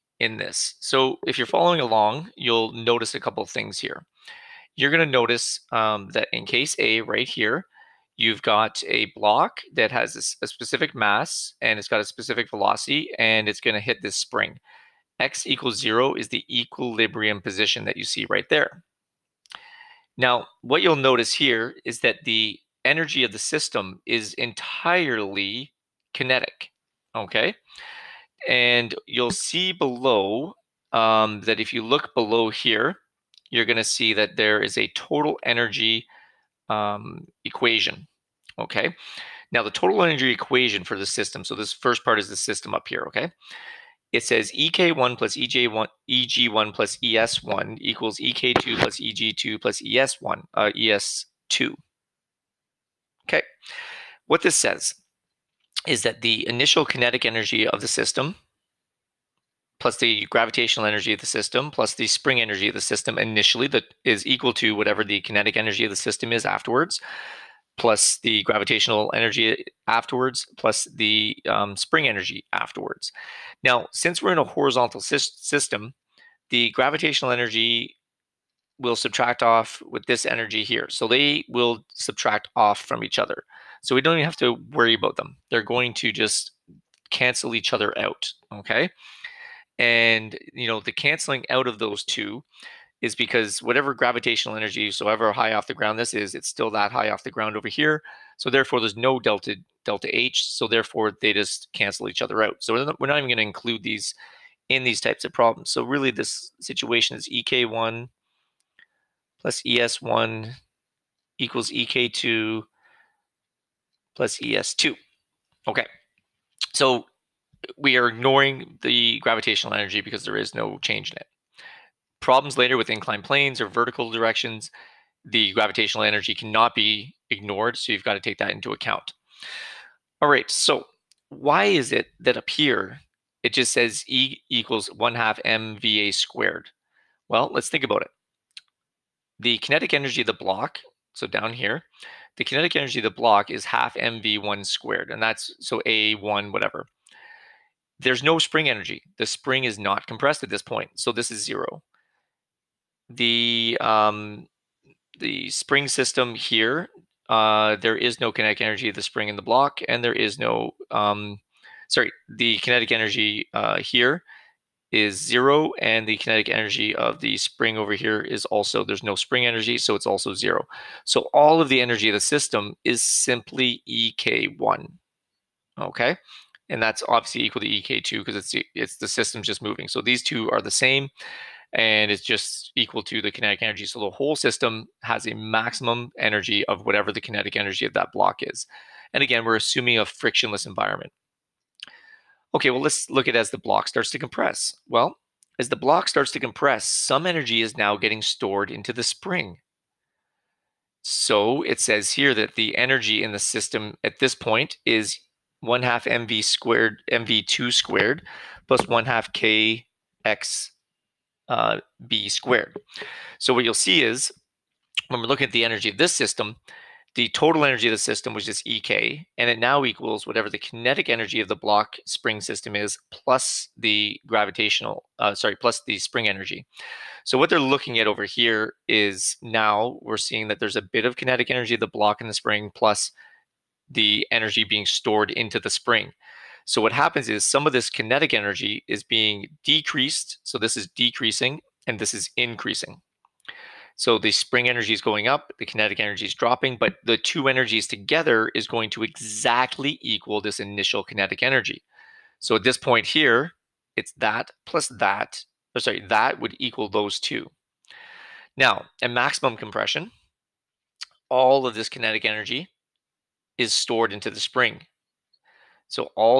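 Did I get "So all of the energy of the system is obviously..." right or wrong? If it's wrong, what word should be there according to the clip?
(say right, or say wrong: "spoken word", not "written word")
wrong: "simply", not "obviously".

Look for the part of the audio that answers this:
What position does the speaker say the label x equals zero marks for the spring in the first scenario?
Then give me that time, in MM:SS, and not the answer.
00:16.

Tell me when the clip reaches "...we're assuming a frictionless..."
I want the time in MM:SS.
03:09.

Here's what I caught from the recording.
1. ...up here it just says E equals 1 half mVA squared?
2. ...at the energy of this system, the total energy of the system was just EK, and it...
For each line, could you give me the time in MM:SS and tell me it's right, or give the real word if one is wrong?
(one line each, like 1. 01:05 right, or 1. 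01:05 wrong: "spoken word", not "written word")
1. 02:12 right
2. 03:35 right.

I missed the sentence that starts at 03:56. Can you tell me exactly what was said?
So what happens is some of this kinetic energy is being decreased.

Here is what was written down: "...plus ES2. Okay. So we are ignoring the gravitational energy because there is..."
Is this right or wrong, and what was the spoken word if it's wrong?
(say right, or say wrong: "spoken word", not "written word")
right.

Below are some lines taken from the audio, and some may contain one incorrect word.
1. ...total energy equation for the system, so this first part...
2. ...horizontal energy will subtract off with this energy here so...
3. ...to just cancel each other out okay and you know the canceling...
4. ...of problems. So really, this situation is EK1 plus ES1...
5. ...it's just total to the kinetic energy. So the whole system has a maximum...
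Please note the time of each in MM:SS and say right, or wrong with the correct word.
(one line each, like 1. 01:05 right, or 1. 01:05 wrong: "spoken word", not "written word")
1. 00:39 right
2. 01:16 wrong: "gravitational", not "horizontal"
3. 01:25 right
4. 01:45 right
5. 03:02 wrong: "equal", not "total".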